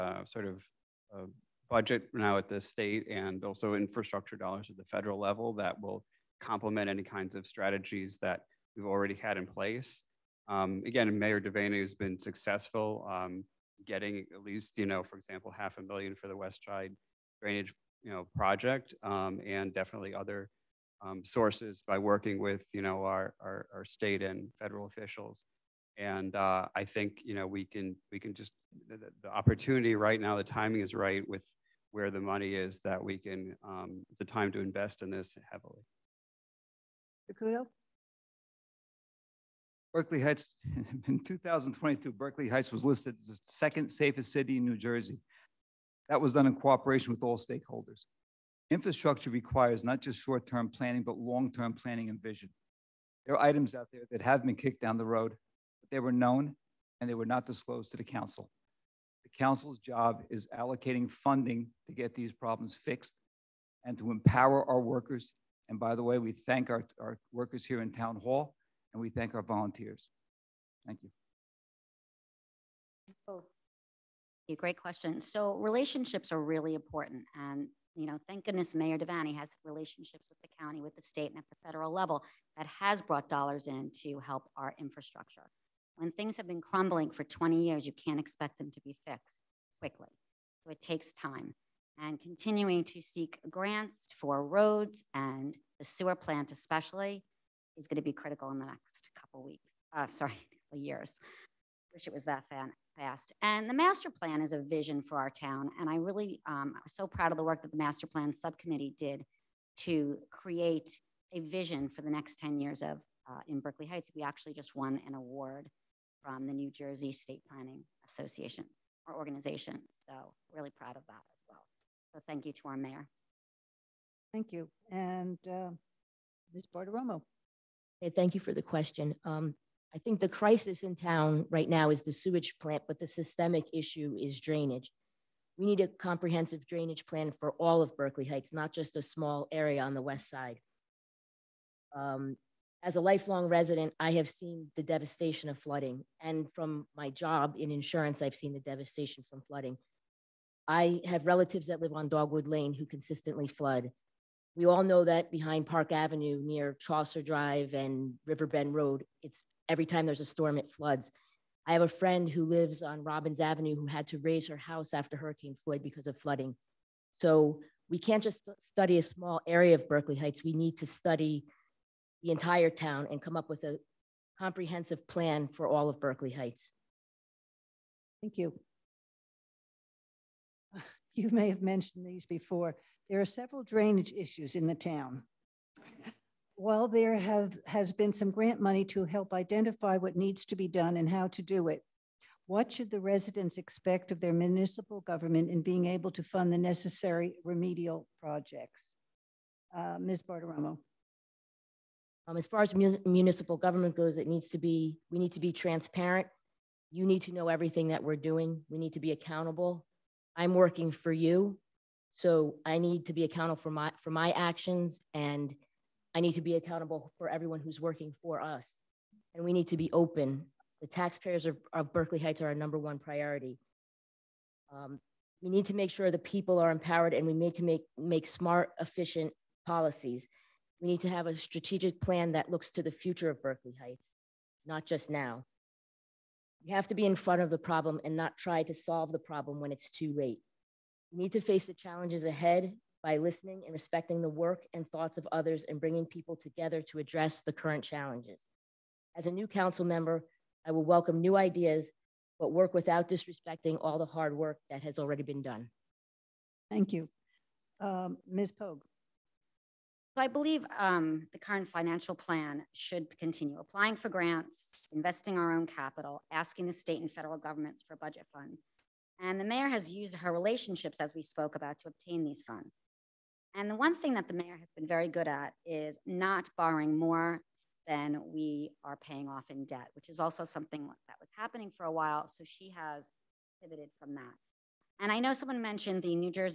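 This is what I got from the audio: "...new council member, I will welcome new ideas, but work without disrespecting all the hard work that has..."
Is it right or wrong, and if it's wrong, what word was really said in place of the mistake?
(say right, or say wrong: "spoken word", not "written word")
right.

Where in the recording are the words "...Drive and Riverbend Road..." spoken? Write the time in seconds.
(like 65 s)
157 s.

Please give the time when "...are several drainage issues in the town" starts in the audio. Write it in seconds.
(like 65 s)
183 s.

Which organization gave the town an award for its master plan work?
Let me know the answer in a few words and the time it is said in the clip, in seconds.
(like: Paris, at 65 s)
New Jersey State Planning Association, at 116 s.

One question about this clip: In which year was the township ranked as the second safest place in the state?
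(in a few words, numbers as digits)
2022.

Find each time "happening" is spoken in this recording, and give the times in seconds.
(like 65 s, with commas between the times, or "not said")
281 s.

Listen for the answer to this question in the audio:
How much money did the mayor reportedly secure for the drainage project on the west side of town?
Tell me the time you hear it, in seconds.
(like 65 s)
15 s.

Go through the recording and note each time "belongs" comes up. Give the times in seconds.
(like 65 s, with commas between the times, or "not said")
not said.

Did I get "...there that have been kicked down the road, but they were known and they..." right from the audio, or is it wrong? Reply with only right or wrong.
right.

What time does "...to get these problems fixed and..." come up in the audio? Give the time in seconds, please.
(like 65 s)
61 s.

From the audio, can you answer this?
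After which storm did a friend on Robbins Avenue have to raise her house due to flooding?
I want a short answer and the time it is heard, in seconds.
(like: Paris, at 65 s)
Hurricane Floyd, at 165 s.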